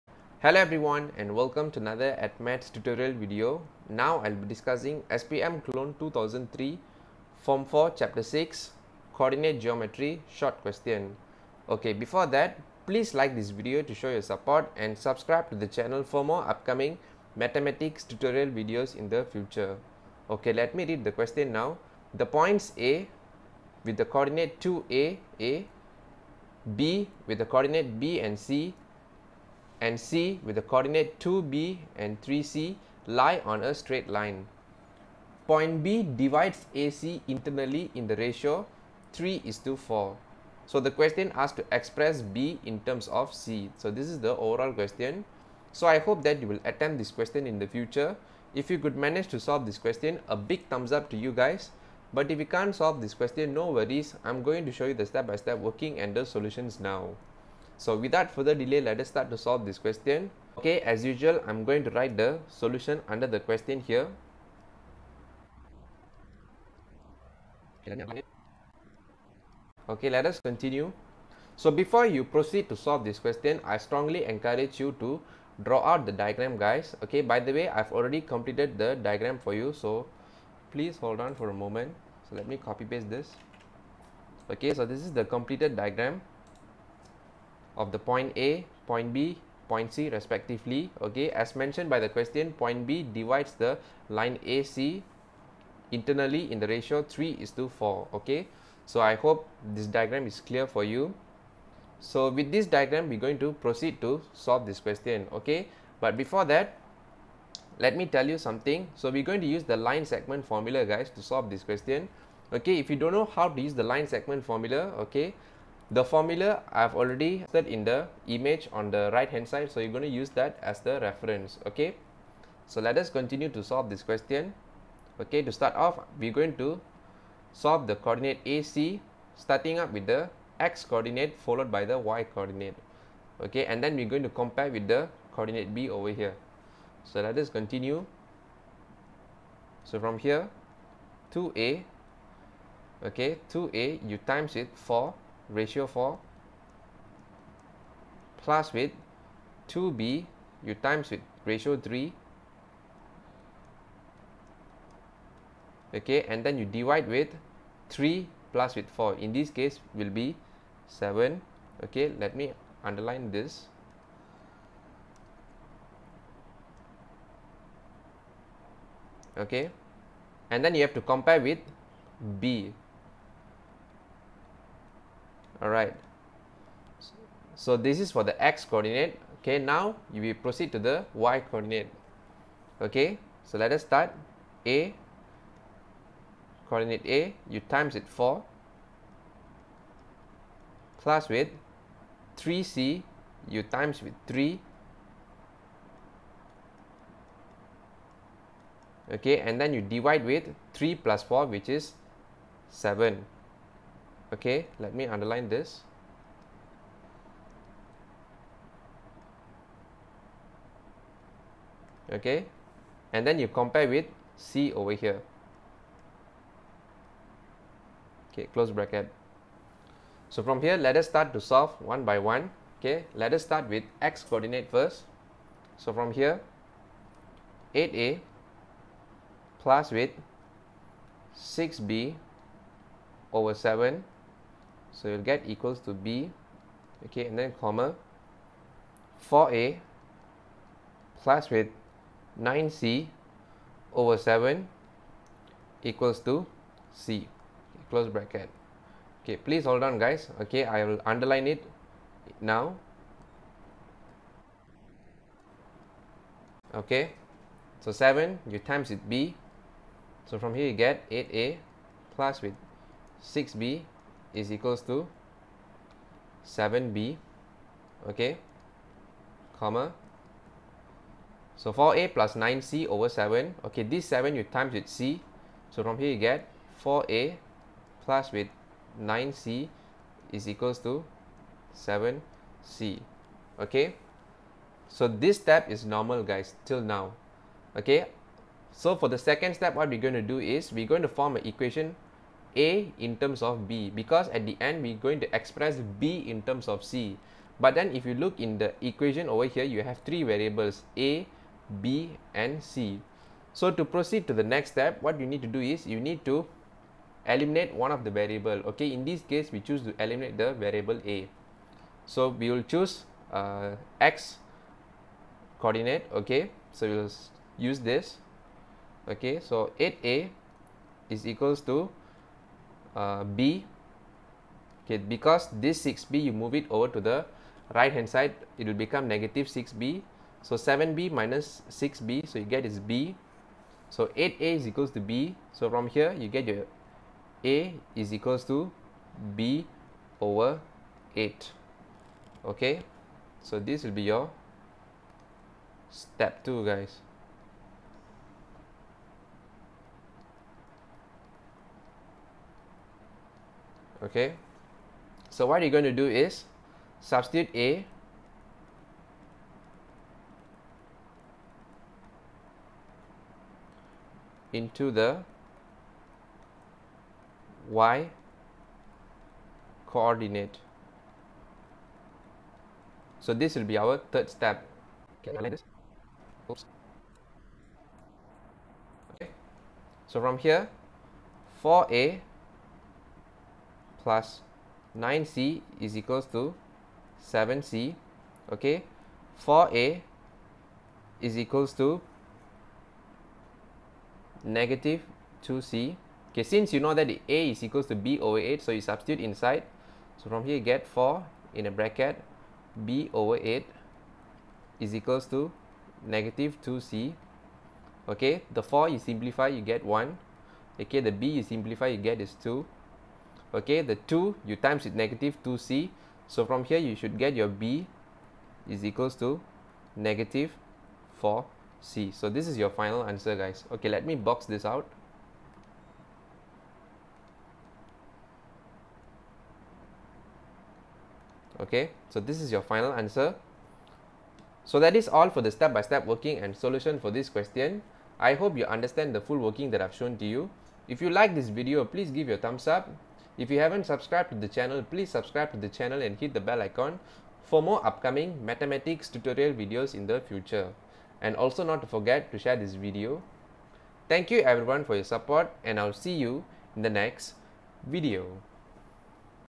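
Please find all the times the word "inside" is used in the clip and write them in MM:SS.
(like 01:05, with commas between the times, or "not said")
06:39.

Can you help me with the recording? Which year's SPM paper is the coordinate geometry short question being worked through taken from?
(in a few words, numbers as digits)
2003.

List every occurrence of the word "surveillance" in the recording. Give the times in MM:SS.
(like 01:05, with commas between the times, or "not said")
not said.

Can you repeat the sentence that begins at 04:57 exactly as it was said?
But then if you look in the equation over here, you have three variables A, B and C.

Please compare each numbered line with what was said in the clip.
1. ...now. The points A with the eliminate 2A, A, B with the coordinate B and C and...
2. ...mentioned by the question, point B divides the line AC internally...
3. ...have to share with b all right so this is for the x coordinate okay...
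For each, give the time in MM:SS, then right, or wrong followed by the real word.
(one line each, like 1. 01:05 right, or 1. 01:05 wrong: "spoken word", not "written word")
1. 00:21 wrong: "coordinate", not "eliminate"
2. 01:31 right
3. 02:50 wrong: "compare", not "share".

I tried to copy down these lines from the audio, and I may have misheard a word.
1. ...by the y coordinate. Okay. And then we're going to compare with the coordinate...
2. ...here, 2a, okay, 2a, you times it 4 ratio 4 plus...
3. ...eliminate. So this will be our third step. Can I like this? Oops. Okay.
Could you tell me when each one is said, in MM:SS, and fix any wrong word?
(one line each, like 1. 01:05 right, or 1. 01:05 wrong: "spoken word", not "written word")
1. 02:11 right
2. 02:20 right
3. 06:09 wrong: "coordinate", not "eliminate".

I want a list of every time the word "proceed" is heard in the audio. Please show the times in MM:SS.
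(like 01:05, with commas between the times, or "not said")
01:12, 01:43, 03:00, 05:03.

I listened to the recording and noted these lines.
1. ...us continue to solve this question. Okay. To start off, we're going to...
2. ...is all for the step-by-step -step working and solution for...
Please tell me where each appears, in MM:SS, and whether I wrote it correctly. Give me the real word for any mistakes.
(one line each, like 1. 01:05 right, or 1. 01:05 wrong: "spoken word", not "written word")
1. 02:02 right
2. 07:14 right.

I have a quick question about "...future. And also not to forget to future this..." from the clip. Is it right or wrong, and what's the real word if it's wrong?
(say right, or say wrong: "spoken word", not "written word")
wrong: "share", not "future".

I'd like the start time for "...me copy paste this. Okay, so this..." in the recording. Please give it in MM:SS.
01:22.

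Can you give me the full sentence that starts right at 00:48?
If you could manage to solve this question, a big thumbs up to you guys.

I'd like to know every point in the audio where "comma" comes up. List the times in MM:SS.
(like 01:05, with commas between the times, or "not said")
03:57, 04:29.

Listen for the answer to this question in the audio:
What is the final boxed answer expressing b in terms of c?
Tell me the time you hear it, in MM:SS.
06:57.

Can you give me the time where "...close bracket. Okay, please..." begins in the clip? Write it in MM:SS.
04:07.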